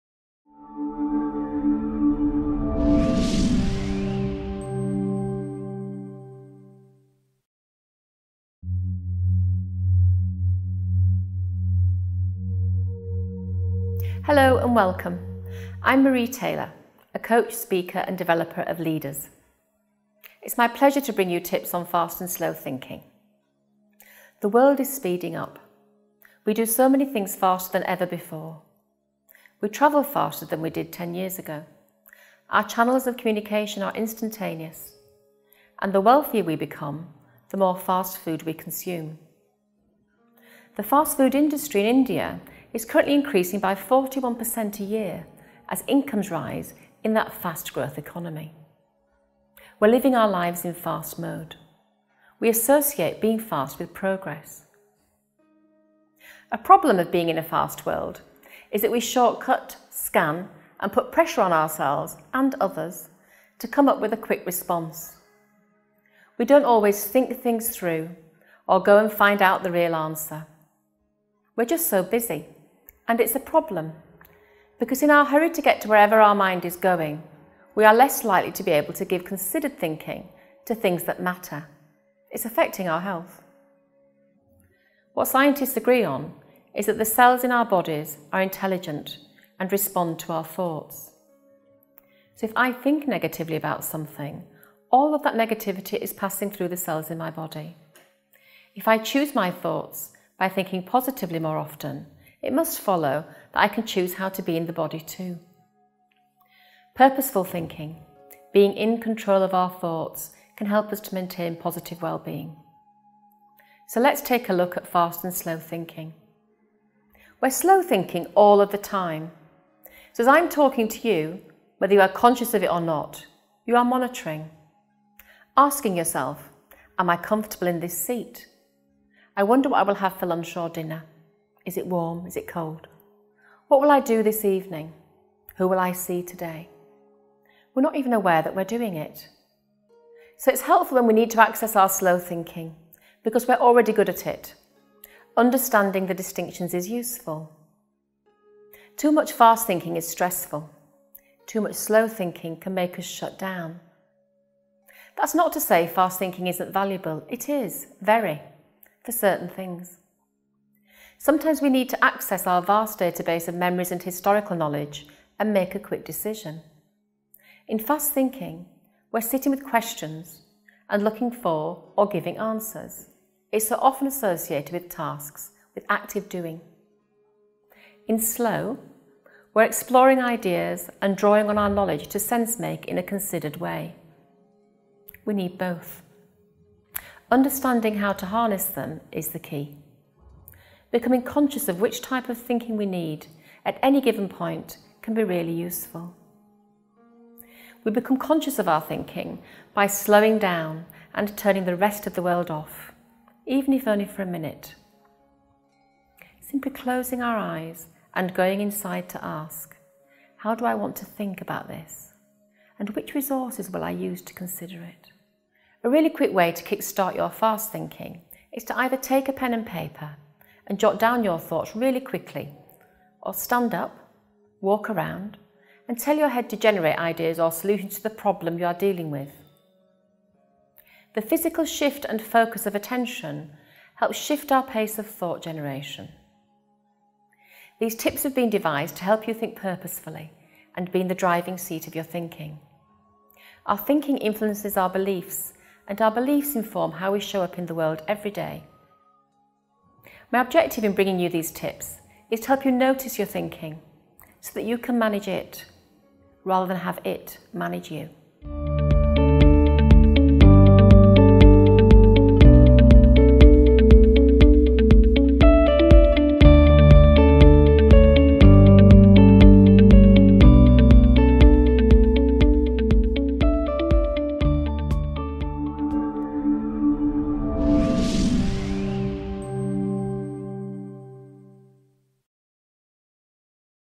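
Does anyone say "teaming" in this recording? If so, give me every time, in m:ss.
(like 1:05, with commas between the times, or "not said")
not said.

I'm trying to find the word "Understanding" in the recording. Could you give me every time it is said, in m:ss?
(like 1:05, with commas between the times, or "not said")
2:25, 3:07.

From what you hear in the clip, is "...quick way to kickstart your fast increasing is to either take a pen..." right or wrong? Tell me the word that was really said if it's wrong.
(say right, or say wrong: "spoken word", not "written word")
wrong: "thinking", not "increasing".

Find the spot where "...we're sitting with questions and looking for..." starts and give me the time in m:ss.
2:49.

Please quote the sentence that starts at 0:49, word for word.
We're living our lives in fast mode.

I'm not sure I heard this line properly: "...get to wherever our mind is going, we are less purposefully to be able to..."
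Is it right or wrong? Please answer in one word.
wrong.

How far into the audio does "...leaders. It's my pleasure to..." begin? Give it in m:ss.
0:18.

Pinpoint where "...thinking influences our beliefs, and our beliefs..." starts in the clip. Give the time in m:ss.
4:03.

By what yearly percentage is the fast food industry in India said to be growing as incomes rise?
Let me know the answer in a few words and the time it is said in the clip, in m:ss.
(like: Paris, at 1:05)
41%, at 0:43.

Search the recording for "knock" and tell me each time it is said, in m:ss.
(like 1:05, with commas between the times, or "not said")
not said.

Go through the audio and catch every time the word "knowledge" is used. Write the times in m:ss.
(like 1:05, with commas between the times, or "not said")
2:44, 3:01.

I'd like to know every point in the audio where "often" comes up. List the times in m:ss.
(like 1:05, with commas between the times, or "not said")
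1:41, 2:53.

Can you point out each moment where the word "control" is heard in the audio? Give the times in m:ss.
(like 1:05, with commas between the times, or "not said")
1:48.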